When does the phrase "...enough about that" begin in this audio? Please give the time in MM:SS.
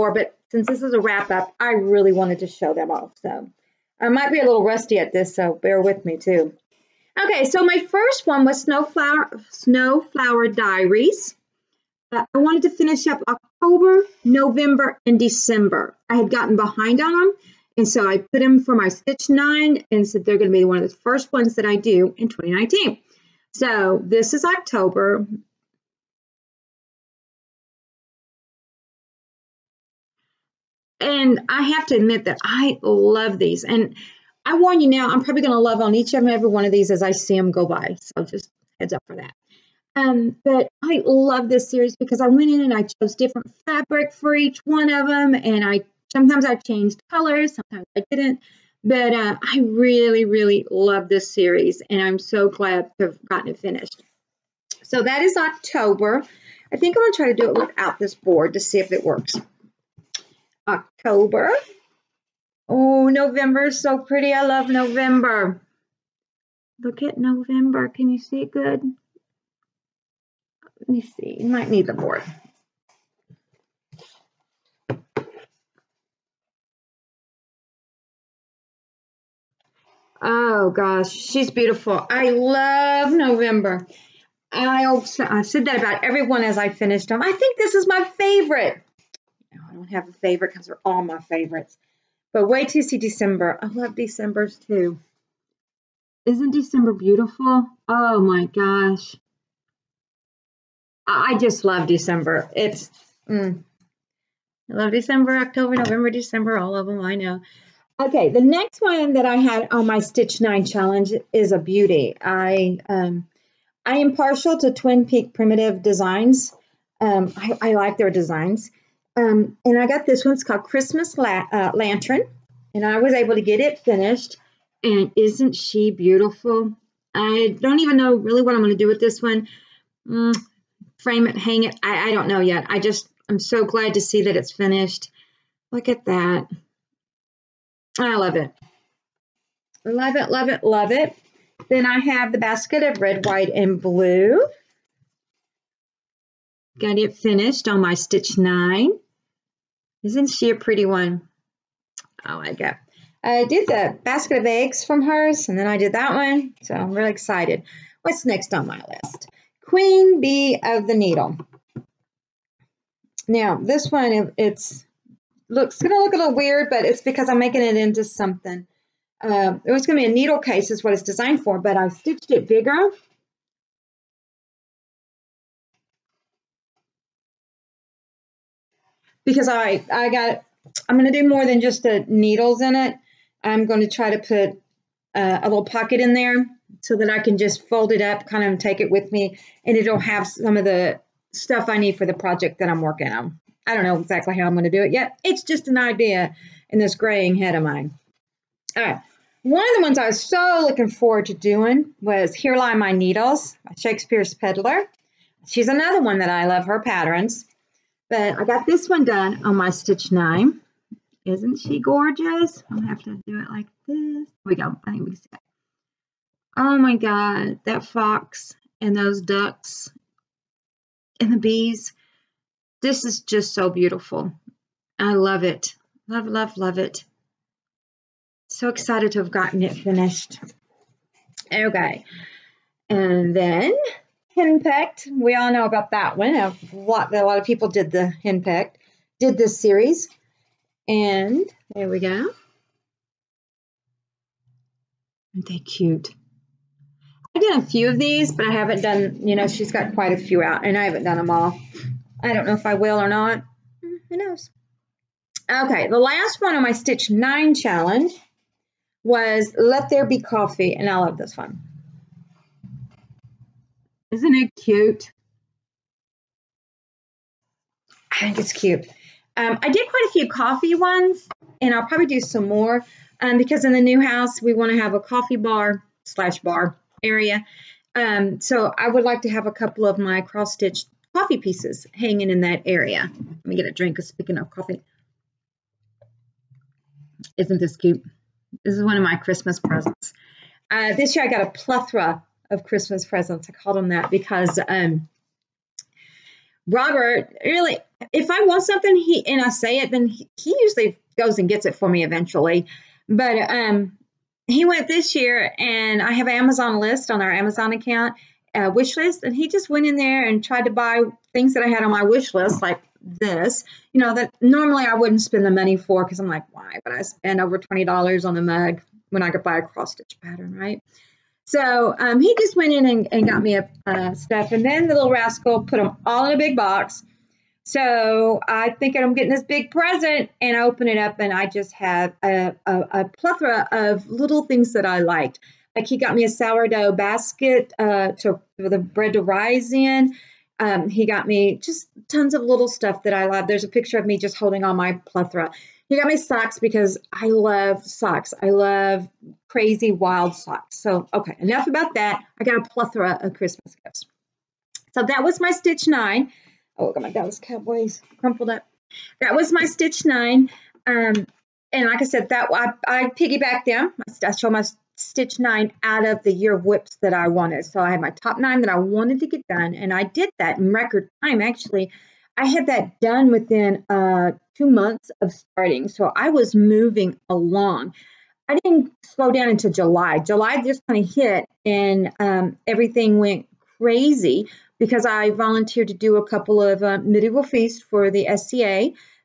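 05:51.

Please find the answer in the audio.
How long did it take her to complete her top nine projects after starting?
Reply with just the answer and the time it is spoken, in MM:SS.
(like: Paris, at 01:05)
2 months, at 06:14.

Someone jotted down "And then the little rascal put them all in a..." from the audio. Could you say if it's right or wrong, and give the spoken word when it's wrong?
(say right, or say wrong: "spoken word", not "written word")
right.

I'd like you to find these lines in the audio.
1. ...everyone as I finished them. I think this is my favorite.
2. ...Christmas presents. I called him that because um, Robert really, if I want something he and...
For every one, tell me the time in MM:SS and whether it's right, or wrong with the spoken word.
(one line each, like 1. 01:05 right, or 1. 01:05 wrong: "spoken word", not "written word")
1. 01:26 right
2. 04:52 right.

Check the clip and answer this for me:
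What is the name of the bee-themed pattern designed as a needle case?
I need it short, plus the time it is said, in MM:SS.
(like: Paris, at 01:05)
Queen Bee of the Needle, at 02:39.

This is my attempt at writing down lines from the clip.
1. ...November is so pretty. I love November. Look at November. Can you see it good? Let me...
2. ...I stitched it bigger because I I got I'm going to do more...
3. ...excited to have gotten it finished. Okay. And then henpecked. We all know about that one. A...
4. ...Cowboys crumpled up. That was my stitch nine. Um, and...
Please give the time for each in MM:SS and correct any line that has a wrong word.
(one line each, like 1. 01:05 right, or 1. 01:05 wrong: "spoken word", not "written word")
1. 01:03 right
2. 02:51 right
3. 03:48 right
4. 05:57 right.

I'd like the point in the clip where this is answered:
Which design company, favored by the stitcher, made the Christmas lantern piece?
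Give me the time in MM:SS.
01:54.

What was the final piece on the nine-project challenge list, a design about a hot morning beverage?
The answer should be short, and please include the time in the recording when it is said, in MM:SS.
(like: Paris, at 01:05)
Let There Be Coffee, at 04:19.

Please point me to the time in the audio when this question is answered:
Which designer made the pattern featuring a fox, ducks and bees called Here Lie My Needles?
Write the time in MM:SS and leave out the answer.
03:23.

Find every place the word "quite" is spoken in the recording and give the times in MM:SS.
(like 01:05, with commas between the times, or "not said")
04:09, 04:29.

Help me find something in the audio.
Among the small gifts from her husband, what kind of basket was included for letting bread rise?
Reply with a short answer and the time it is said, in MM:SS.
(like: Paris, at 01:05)
sourdough basket, at 05:36.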